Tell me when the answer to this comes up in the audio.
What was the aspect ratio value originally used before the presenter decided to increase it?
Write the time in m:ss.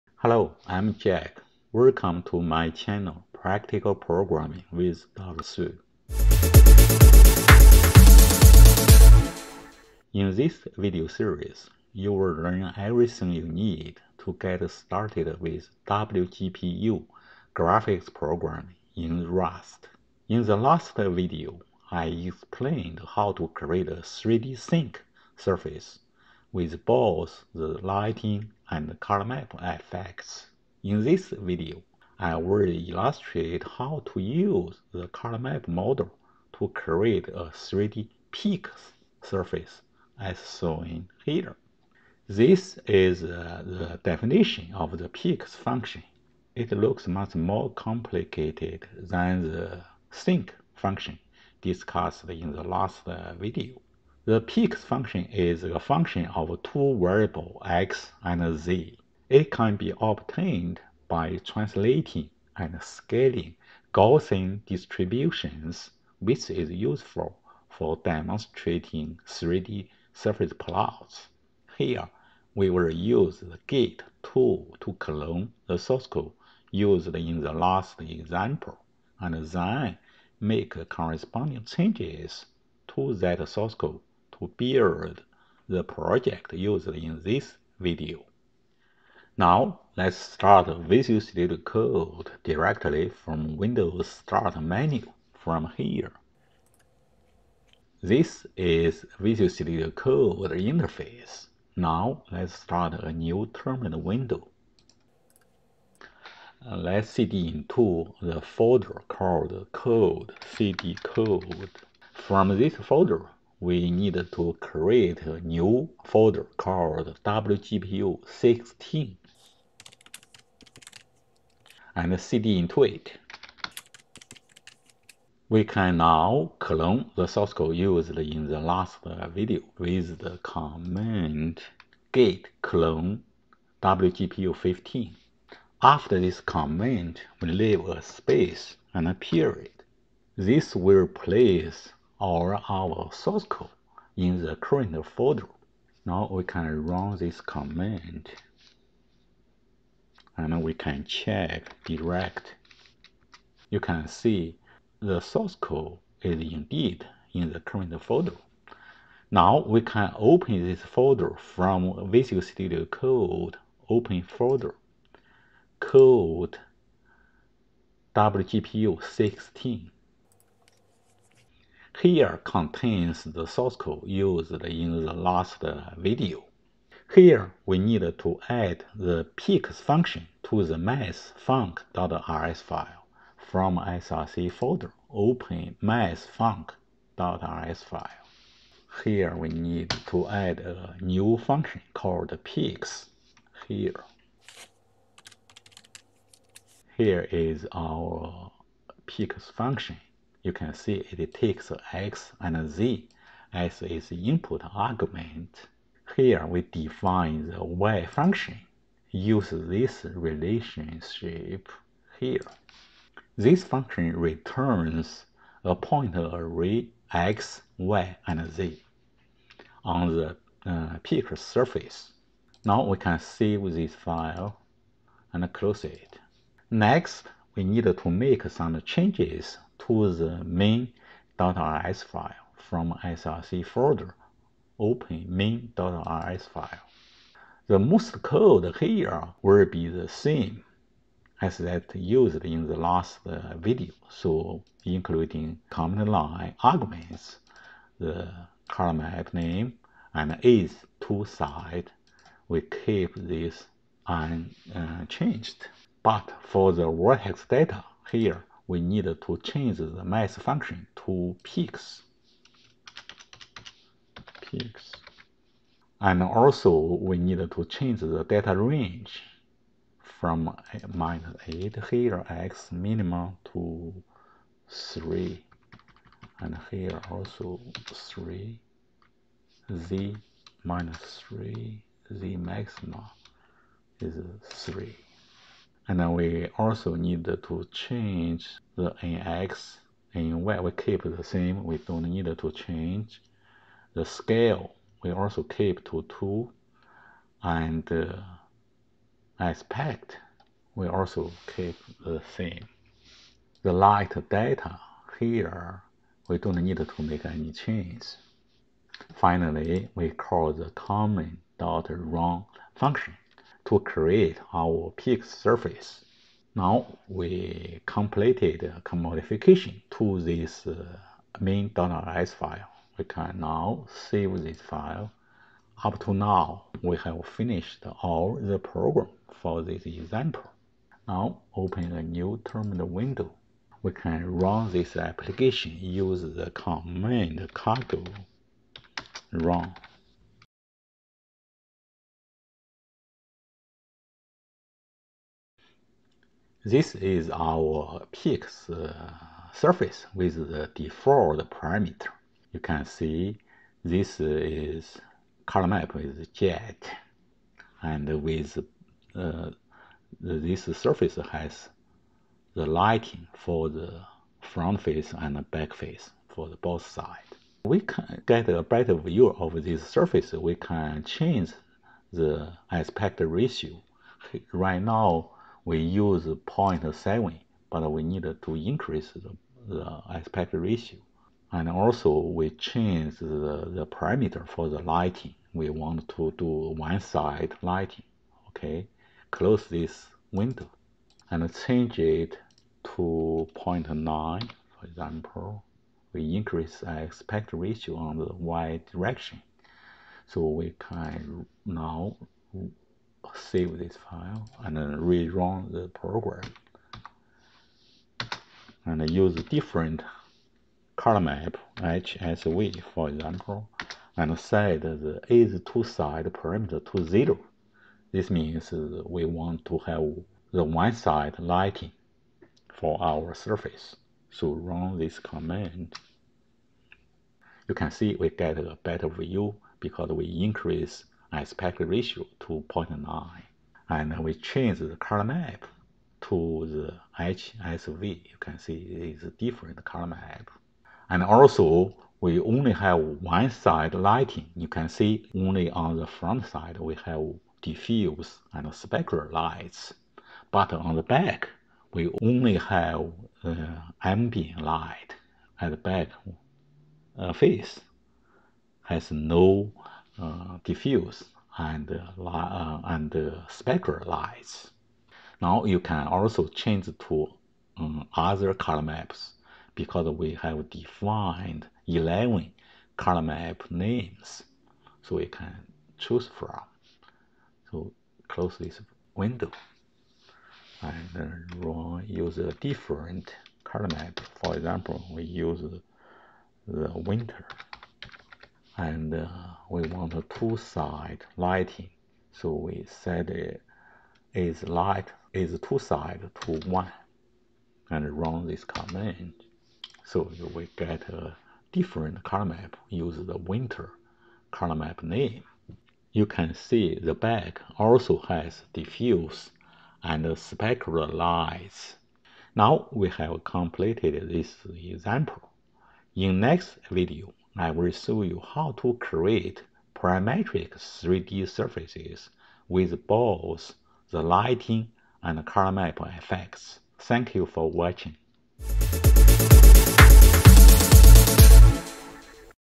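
6:16.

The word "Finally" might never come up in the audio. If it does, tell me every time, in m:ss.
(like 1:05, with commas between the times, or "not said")
5:09.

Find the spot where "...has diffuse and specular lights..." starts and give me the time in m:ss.
8:28.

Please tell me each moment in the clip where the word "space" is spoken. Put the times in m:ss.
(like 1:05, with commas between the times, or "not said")
2:18.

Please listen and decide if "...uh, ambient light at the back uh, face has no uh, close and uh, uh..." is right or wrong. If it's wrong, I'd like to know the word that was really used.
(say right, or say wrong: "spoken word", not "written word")
wrong: "diffuse", not "close".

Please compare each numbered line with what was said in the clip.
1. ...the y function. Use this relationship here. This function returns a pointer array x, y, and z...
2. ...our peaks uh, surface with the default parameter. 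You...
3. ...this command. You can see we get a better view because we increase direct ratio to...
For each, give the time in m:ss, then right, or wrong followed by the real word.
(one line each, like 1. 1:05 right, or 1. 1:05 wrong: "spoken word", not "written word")
1. 3:27 right
2. 5:47 right
3. 7:04 wrong: "aspect", not "direct".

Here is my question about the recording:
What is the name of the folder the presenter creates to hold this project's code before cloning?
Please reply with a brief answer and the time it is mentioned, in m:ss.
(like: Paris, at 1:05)
WGPU16, at 1:57.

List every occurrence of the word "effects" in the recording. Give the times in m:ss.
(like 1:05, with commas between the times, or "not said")
0:29, 8:45.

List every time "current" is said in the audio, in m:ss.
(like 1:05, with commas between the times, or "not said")
2:24, 2:37.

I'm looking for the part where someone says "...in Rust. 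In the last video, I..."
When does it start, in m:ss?
0:18.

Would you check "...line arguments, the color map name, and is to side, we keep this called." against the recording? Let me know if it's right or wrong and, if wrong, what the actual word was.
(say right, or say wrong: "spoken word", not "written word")
wrong: "unchanged", not "called".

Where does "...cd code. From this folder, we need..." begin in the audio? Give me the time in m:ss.
1:50.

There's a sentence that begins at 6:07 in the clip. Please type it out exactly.
We can get a better view of this surface.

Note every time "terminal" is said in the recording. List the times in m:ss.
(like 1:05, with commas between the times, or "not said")
1:43, 5:32.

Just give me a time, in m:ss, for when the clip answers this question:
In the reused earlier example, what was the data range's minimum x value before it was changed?
4:30.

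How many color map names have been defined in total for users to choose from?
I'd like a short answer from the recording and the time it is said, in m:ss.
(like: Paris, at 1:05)
11, at 7:51.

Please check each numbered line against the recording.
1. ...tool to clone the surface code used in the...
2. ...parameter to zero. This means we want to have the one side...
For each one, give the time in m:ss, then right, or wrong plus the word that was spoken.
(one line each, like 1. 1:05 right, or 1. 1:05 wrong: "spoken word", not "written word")
1. 1:14 wrong: "source", not "surface"
2. 6:56 right.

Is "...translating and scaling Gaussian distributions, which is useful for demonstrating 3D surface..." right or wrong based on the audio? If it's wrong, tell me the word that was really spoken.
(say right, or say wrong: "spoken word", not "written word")
right.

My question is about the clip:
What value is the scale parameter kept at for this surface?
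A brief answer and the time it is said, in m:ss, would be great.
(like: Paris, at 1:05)
2, at 4:56.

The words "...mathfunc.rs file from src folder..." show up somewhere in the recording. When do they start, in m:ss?
3:00.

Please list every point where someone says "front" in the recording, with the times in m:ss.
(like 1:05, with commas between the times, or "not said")
6:04, 7:26.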